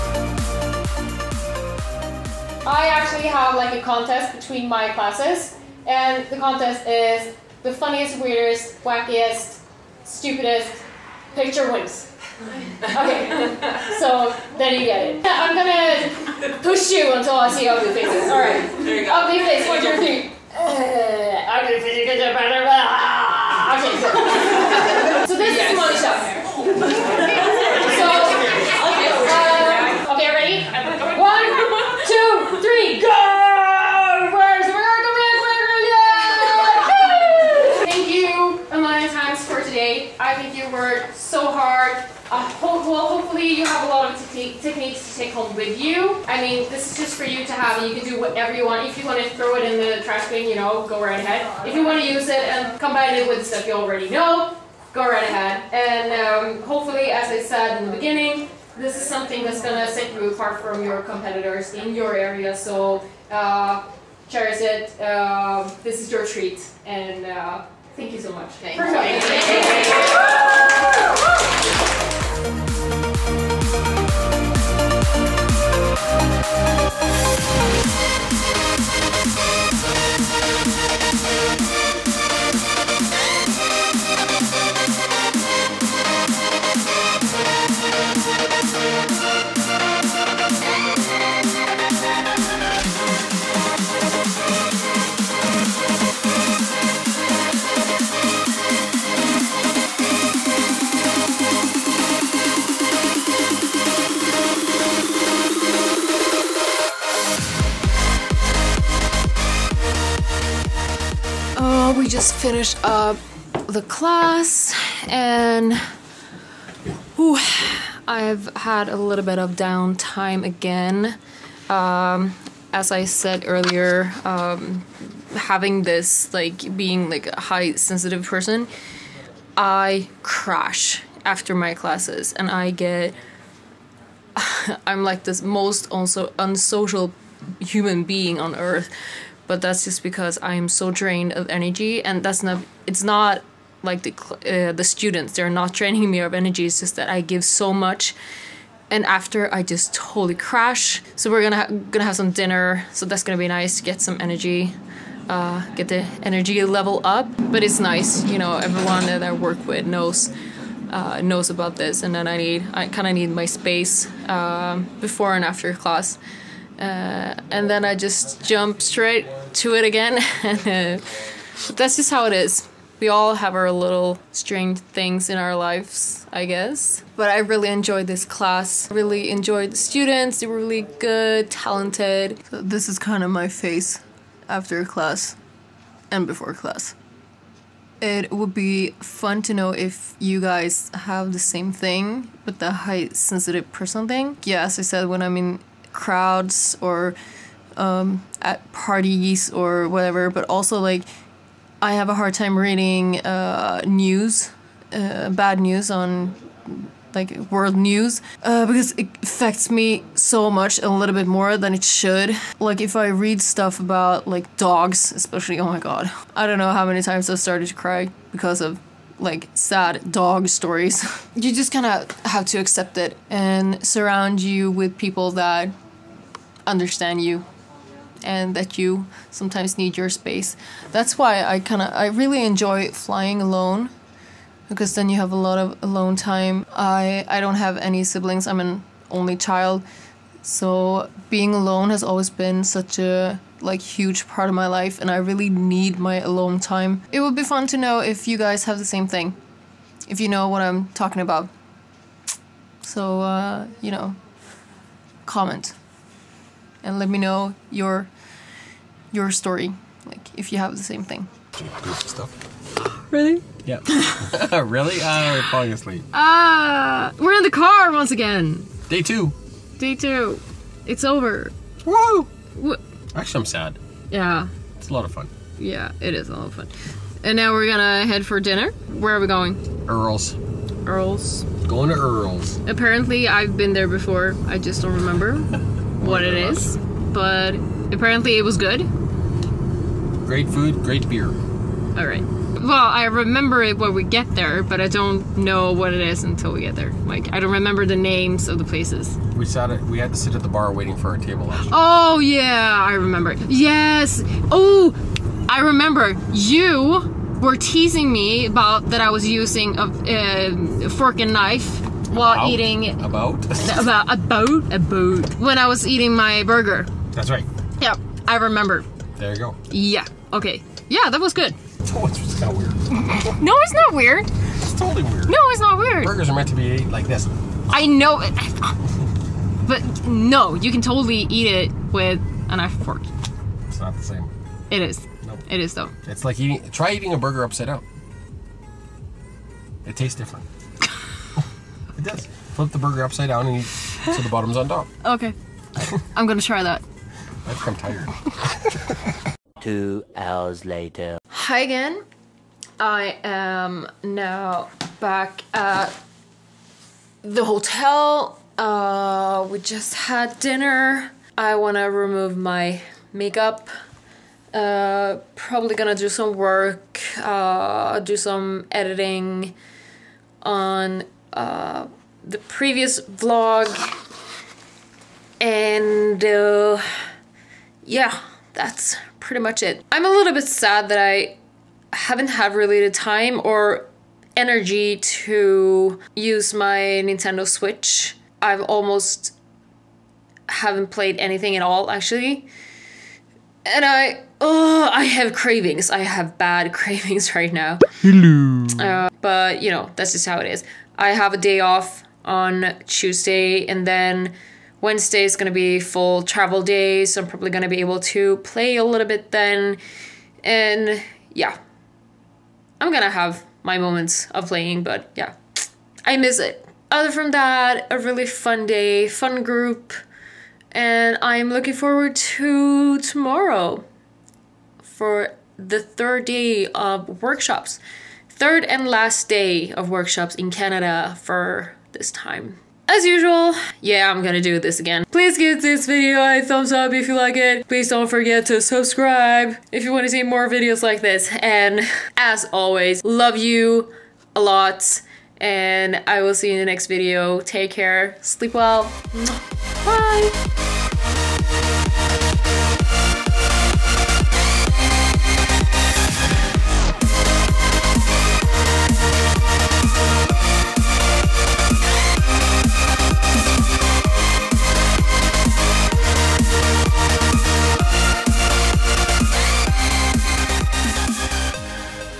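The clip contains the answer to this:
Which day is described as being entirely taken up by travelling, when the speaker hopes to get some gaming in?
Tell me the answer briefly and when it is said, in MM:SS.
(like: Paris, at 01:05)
Wednesday, at 06:44.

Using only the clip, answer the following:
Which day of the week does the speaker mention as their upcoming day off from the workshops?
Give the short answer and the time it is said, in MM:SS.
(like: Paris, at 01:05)
Tuesday, at 06:42.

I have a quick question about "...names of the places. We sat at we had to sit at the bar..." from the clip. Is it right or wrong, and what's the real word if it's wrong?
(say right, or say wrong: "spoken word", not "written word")
right.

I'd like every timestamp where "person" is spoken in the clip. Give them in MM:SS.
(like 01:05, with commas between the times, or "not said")
02:08, 03:13.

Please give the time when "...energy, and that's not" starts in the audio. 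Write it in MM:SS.
02:21.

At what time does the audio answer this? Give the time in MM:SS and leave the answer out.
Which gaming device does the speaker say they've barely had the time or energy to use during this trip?
06:27.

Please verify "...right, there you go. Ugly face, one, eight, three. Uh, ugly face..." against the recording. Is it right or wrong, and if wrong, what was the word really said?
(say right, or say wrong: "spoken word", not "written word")
wrong: "two", not "eight".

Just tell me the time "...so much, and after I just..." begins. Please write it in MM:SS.
02:27.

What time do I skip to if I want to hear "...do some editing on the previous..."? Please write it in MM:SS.
06:07.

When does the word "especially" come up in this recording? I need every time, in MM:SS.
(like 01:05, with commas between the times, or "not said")
03:35.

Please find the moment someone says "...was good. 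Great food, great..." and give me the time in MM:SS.
04:48.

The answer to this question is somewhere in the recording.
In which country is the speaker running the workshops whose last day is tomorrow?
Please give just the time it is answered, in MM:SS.
07:10.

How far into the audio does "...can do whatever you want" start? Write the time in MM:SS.
00:47.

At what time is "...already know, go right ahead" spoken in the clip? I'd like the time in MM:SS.
00:53.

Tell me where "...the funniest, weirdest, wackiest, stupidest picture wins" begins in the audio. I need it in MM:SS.
00:07.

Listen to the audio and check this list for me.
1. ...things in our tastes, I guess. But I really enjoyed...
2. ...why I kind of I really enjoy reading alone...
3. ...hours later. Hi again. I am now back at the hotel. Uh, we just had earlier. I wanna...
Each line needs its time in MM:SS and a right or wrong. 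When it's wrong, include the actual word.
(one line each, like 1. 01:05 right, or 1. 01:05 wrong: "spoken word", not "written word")
1. 02:54 wrong: "lives", not "tastes"
2. 03:51 wrong: "flying", not "reading"
3. 05:50 wrong: "dinner", not "earlier".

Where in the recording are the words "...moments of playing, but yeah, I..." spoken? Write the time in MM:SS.
06:53.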